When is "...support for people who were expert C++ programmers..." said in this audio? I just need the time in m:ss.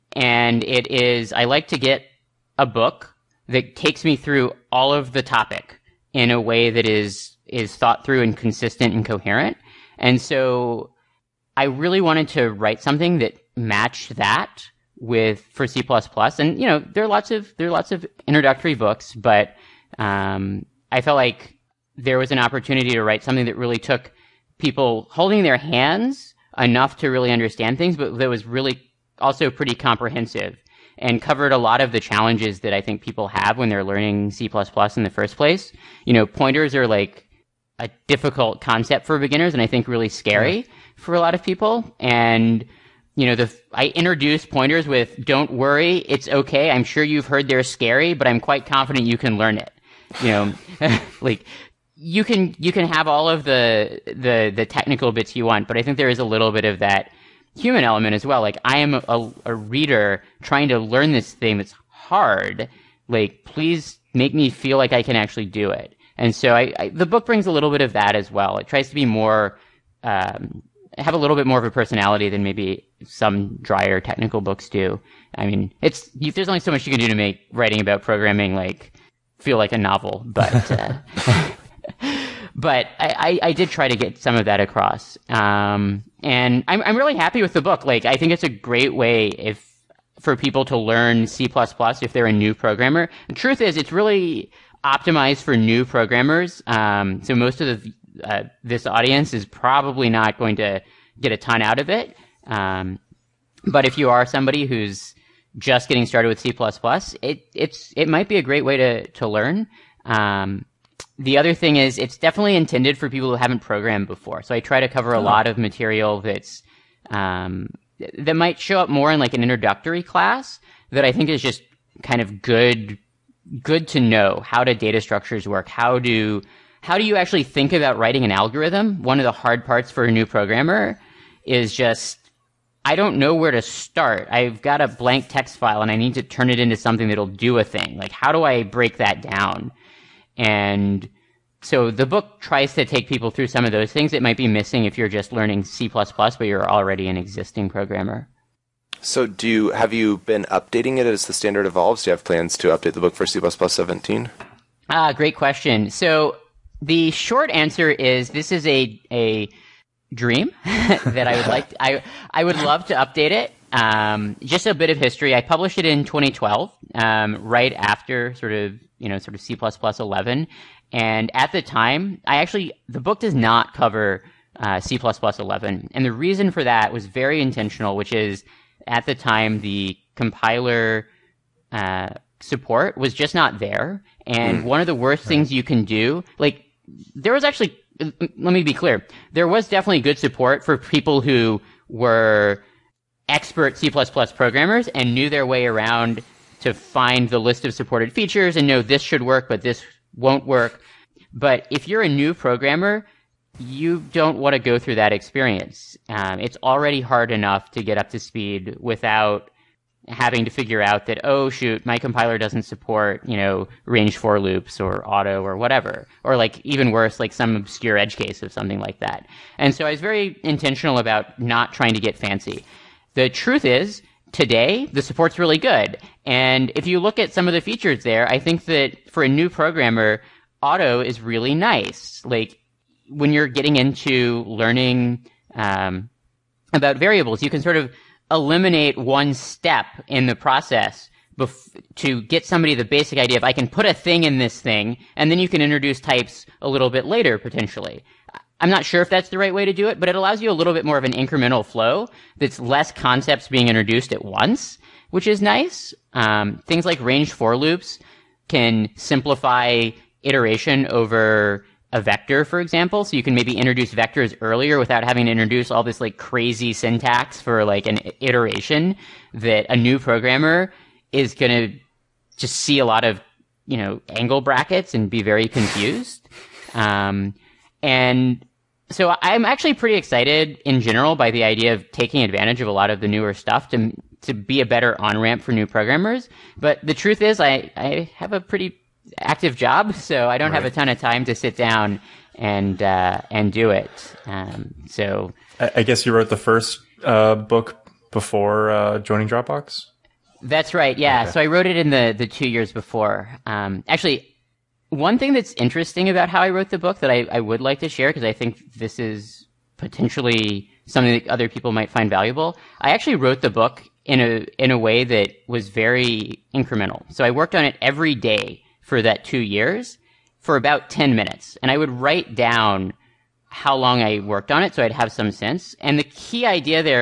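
3:10.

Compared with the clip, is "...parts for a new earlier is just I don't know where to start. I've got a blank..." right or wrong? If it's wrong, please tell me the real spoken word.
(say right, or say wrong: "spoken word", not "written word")
wrong: "programmer", not "earlier".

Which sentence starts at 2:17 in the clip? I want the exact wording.
Like, how do I break that down?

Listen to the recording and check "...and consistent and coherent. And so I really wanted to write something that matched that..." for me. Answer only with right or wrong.
right.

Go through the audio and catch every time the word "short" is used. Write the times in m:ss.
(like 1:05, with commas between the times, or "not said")
2:37.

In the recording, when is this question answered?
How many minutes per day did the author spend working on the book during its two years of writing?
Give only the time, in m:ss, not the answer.
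5:20.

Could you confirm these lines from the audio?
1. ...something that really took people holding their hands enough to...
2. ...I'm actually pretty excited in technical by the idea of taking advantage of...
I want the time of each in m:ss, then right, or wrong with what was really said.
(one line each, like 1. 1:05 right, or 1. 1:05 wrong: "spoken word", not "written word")
1. 0:23 right
2. 4:39 wrong: "general", not "technical".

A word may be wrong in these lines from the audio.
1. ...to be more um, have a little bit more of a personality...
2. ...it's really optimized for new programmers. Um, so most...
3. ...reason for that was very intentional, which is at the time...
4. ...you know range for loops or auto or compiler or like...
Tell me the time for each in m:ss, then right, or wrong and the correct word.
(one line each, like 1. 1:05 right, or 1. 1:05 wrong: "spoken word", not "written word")
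1. 1:08 right
2. 1:33 right
3. 2:56 right
4. 3:33 wrong: "whatever", not "compiler".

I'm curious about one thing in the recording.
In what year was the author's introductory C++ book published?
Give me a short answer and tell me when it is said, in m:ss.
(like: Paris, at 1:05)
2012, at 2:46.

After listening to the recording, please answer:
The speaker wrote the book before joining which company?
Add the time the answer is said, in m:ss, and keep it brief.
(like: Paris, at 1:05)
Dropbox, at 4:59.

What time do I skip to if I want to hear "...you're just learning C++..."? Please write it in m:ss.
2:24.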